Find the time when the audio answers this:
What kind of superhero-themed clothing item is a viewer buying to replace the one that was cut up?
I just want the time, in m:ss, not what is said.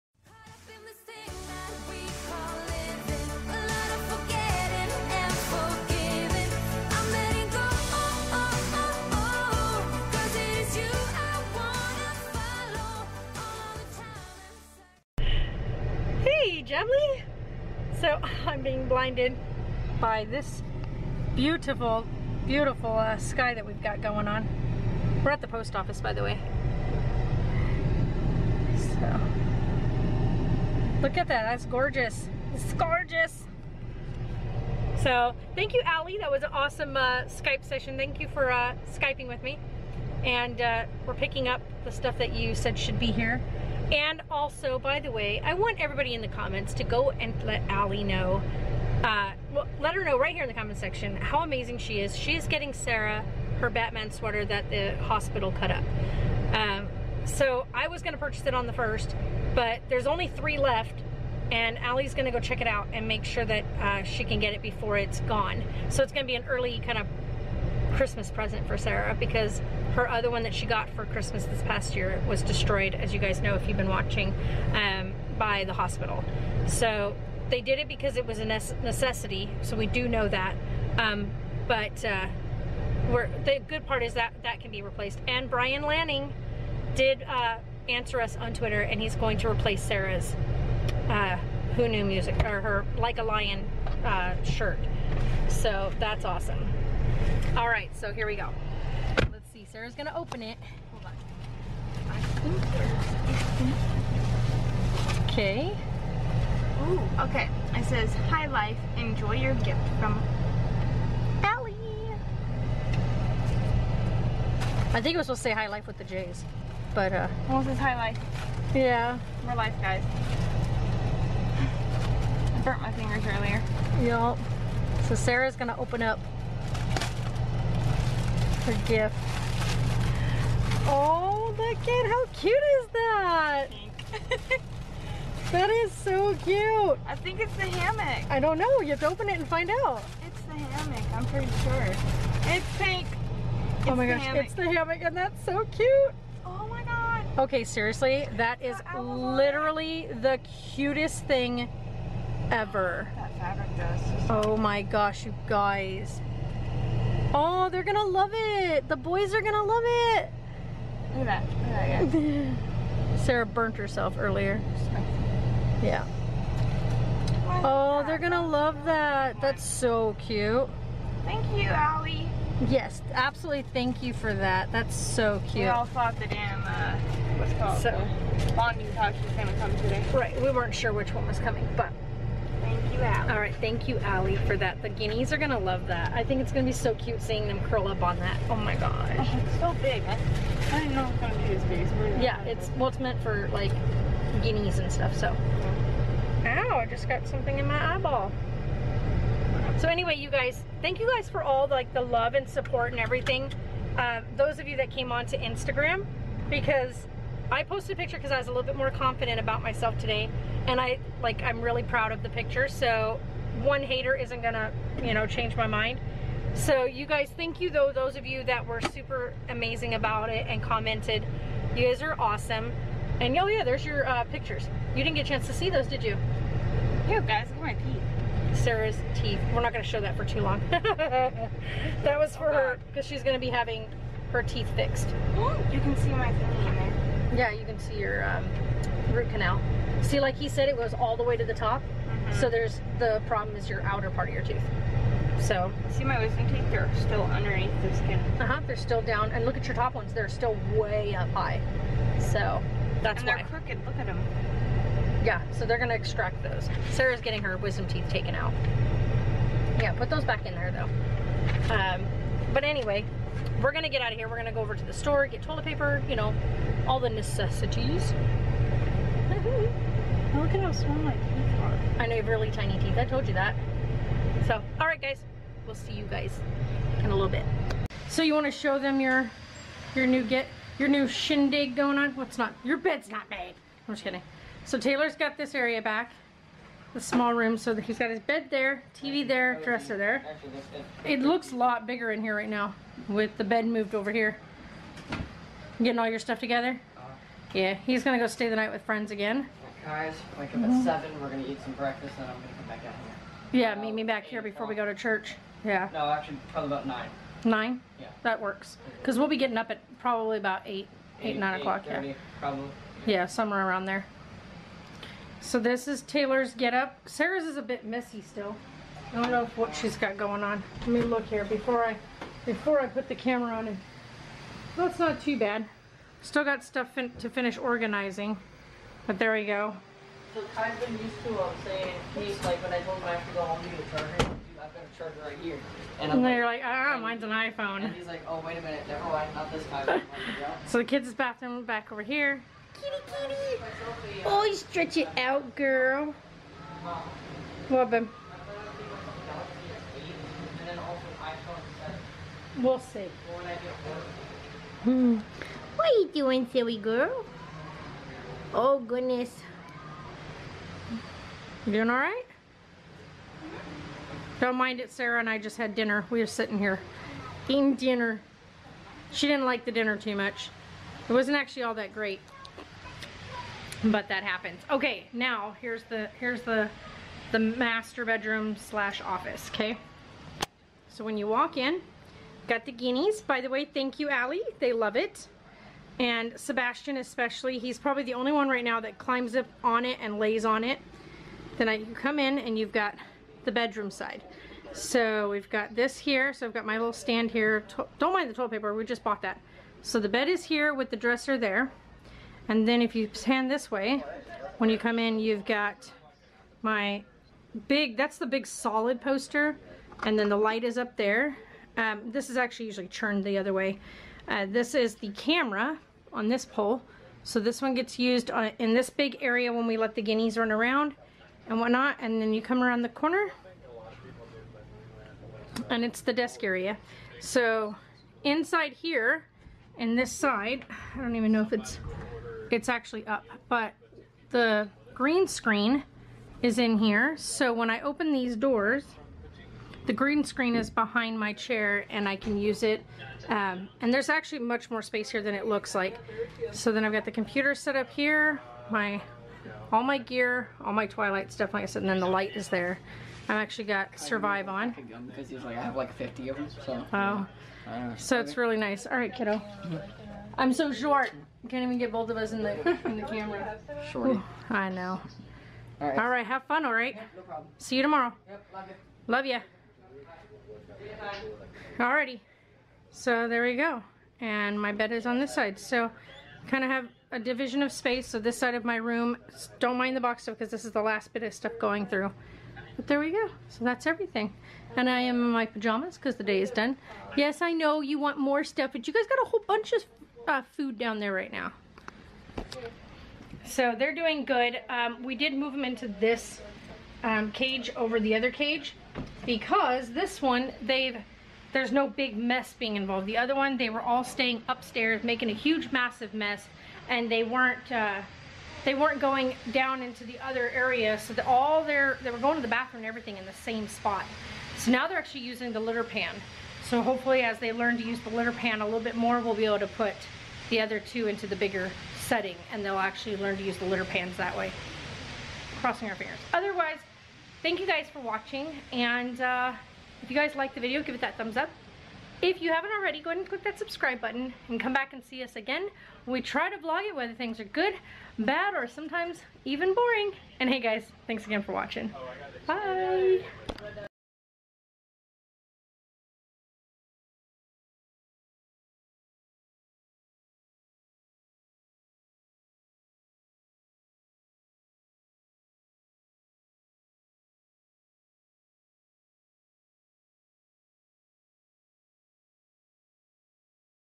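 0:53.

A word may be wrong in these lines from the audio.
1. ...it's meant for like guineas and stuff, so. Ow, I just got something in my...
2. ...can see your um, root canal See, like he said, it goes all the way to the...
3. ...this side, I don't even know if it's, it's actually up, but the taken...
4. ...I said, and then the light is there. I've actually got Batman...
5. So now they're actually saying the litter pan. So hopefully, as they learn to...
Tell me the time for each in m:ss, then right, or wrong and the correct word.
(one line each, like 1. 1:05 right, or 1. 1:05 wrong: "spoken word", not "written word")
1. 3:12 right
2. 3:57 right
3. 7:09 wrong: "green", not "taken"
4. 7:31 wrong: "Survive", not "Batman"
5. 8:34 wrong: "using", not "saying".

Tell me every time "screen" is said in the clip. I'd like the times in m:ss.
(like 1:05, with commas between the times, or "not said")
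7:15, 7:20.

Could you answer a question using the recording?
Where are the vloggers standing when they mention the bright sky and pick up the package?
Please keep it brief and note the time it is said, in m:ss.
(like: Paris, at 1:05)
Post office, at 0:25.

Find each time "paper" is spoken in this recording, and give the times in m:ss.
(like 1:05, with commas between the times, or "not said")
4:25, 6:38.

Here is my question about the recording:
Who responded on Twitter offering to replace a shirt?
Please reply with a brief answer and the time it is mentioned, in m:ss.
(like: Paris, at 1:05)
Brian Lanning, at 1:25.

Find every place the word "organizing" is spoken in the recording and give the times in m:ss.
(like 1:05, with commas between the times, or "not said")
5:27.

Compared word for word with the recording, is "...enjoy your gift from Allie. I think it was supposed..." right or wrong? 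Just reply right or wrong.
right.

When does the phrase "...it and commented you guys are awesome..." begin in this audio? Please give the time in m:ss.
3:40.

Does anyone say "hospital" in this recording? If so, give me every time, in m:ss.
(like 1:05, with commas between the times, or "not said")
0:55, 1:15.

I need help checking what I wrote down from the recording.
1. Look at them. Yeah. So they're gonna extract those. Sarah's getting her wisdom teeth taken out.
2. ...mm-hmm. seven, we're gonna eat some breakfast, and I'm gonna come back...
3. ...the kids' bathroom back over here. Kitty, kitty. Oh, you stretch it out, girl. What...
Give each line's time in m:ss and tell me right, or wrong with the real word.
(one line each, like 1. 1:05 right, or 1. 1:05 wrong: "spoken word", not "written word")
1. 4:13 right
2. 5:00 right
3. 5:40 right.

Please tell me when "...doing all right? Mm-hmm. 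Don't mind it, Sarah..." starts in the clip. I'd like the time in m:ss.
6:01.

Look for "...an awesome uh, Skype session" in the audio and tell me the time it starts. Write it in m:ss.
0:36.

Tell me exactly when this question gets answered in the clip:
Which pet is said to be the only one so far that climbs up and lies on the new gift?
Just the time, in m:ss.
6:26.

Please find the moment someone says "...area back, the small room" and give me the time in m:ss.
4:45.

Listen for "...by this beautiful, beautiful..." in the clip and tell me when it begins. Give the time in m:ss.
0:19.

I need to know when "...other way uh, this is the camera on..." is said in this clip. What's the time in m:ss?
6:53.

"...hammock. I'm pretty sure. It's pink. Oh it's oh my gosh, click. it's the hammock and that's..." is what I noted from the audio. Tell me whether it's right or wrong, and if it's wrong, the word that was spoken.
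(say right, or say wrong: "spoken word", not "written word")
wrong: "hammock", not "click".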